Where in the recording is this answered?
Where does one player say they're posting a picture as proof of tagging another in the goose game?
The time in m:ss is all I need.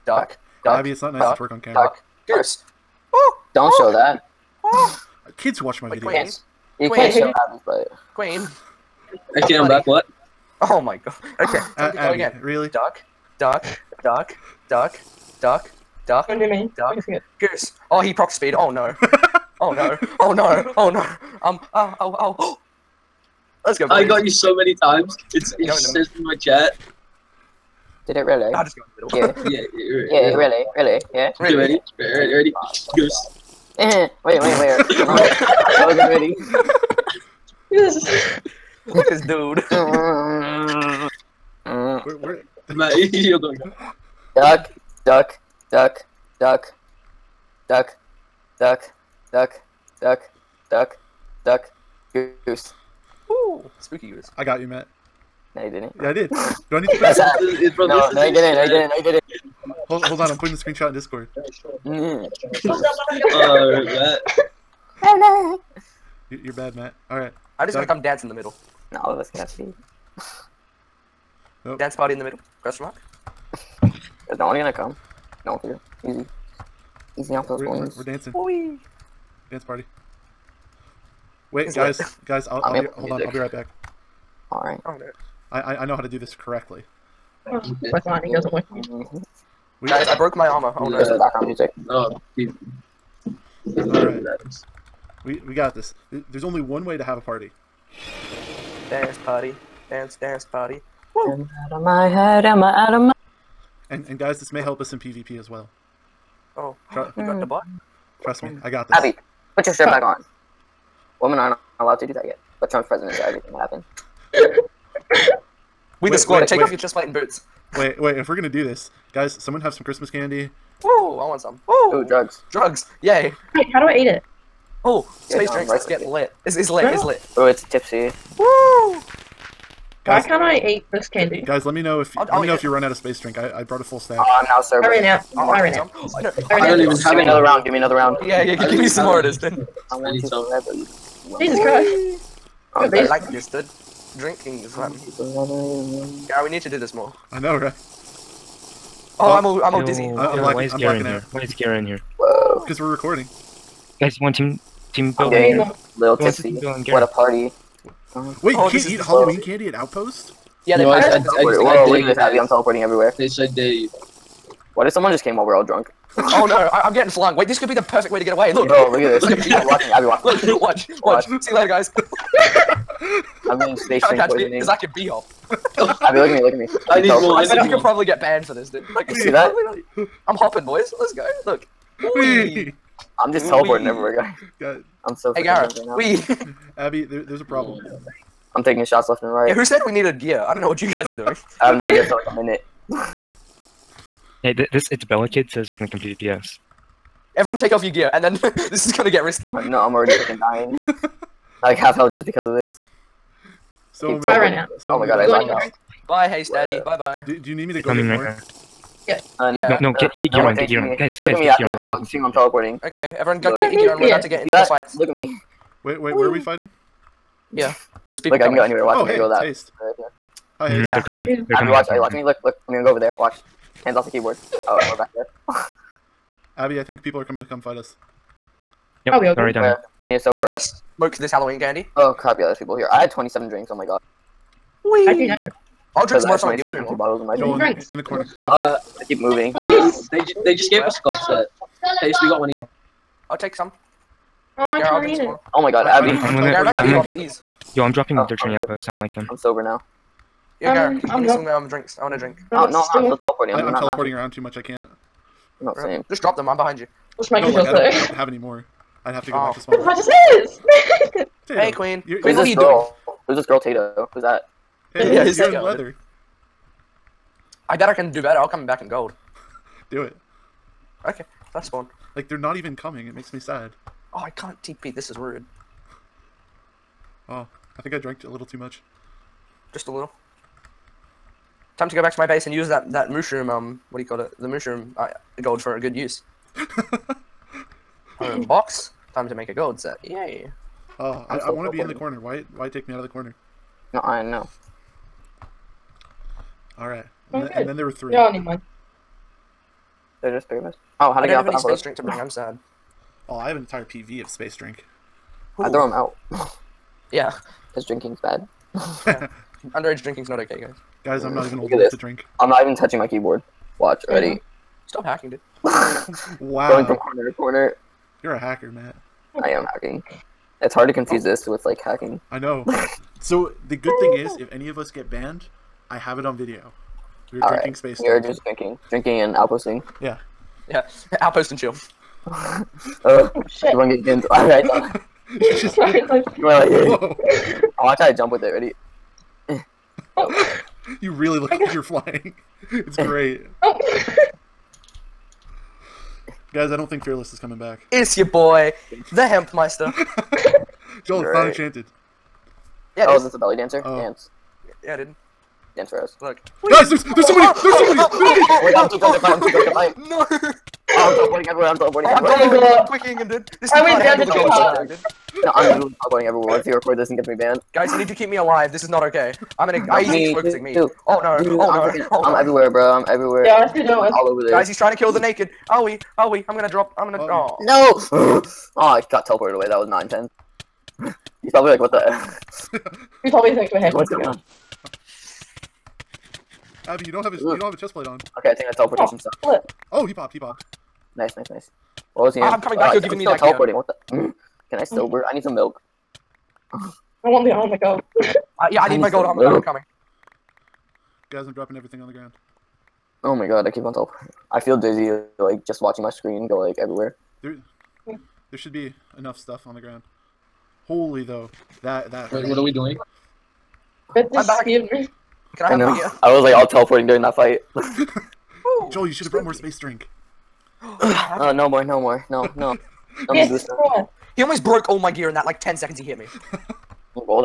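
1:00.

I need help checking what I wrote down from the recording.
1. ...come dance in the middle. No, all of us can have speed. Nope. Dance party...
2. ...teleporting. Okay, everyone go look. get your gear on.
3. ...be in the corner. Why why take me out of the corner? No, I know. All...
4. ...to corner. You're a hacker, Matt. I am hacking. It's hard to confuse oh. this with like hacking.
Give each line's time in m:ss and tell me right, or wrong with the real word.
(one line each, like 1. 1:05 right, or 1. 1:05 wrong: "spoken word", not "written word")
1. 1:07 right
2. 3:32 right
3. 4:51 right
4. 5:17 right.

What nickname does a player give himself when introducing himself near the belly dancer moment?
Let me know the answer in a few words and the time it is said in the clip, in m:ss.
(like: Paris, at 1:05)
The Hempmeister, at 5:49.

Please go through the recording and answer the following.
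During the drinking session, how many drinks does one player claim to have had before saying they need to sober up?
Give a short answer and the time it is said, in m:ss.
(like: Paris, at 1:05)
27, at 3:52.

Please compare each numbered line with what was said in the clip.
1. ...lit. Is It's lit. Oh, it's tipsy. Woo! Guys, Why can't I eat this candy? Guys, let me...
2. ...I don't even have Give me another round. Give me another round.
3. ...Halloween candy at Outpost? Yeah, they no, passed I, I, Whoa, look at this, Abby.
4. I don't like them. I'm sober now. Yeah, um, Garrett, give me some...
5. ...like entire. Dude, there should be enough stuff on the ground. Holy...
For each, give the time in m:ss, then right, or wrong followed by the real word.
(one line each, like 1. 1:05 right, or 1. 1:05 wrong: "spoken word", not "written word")
1. 2:06 right
2. 2:16 right
3. 2:38 right
4. 4:08 right
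5. 6:46 wrong: "everywhere", not "entire".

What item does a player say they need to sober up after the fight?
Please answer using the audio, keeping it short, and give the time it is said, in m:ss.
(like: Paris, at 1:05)
Milk, at 6:35.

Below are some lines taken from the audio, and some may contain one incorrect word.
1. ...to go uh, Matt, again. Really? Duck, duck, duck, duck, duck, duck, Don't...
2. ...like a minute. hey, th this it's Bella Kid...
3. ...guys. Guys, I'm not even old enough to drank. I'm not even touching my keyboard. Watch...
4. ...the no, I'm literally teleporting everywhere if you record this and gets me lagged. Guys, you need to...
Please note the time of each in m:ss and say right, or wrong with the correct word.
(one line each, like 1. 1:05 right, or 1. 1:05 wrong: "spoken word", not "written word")
1. 0:11 wrong: "Abby", not "Matt"
2. 3:12 right
3. 5:10 wrong: "drink", not "drank"
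4. 6:04 wrong: "banned", not "lagged".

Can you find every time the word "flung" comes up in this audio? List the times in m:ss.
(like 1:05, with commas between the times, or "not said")
2:47.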